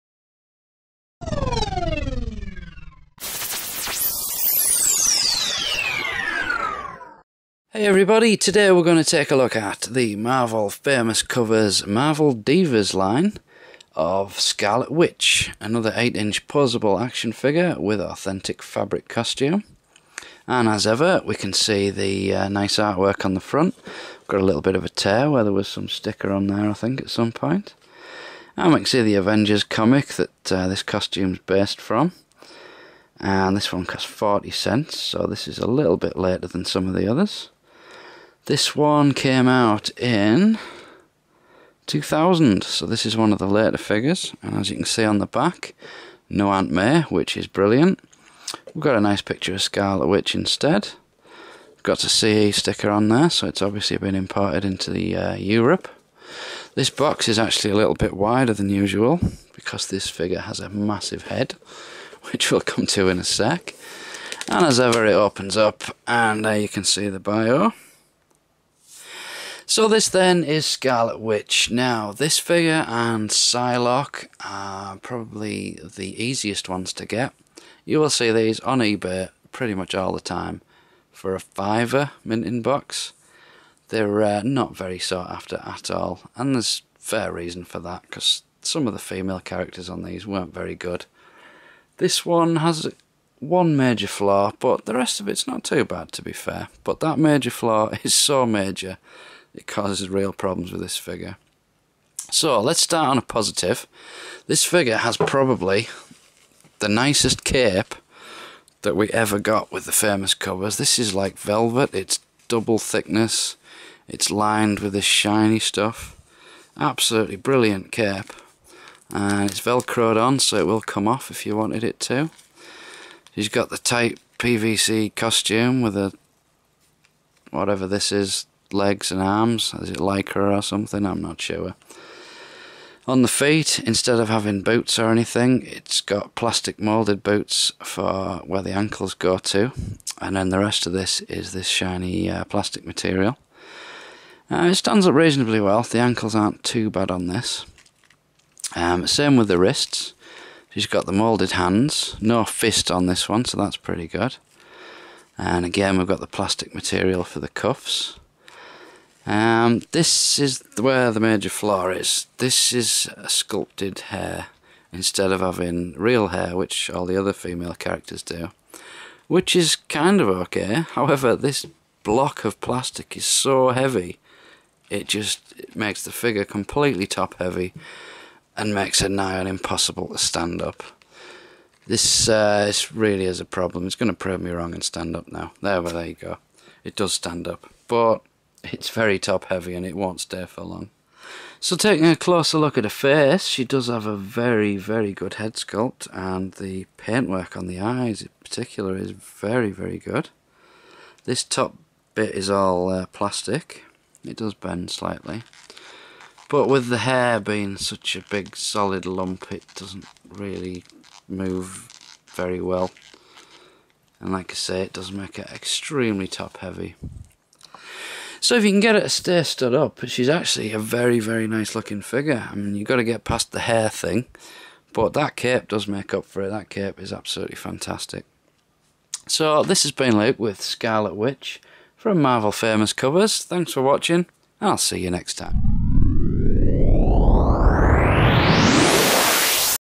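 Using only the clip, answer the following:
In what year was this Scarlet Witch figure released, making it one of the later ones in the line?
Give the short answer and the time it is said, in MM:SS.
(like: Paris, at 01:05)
2000, at 00:41.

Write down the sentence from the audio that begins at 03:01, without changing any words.
This, uh, this really is a problem.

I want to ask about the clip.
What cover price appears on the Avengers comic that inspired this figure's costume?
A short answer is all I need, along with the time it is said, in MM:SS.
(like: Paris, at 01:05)
40 cents, at 00:34.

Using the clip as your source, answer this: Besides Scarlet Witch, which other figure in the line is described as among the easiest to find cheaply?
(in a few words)
Psylocke.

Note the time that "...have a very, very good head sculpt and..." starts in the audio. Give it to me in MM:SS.
03:13.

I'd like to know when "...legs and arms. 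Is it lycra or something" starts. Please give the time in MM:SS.
02:08.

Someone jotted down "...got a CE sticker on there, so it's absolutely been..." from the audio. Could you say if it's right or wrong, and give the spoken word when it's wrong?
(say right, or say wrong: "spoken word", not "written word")
wrong: "obviously", not "absolutely".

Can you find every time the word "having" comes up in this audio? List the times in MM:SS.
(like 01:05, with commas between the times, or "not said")
02:14, 02:45.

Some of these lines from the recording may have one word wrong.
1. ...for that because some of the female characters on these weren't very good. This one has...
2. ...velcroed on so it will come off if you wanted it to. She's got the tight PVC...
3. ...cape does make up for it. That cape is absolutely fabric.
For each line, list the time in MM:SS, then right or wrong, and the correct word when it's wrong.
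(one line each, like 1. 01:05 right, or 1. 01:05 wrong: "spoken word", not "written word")
1. 01:27 right
2. 01:59 right
3. 03:45 wrong: "fantastic", not "fabric".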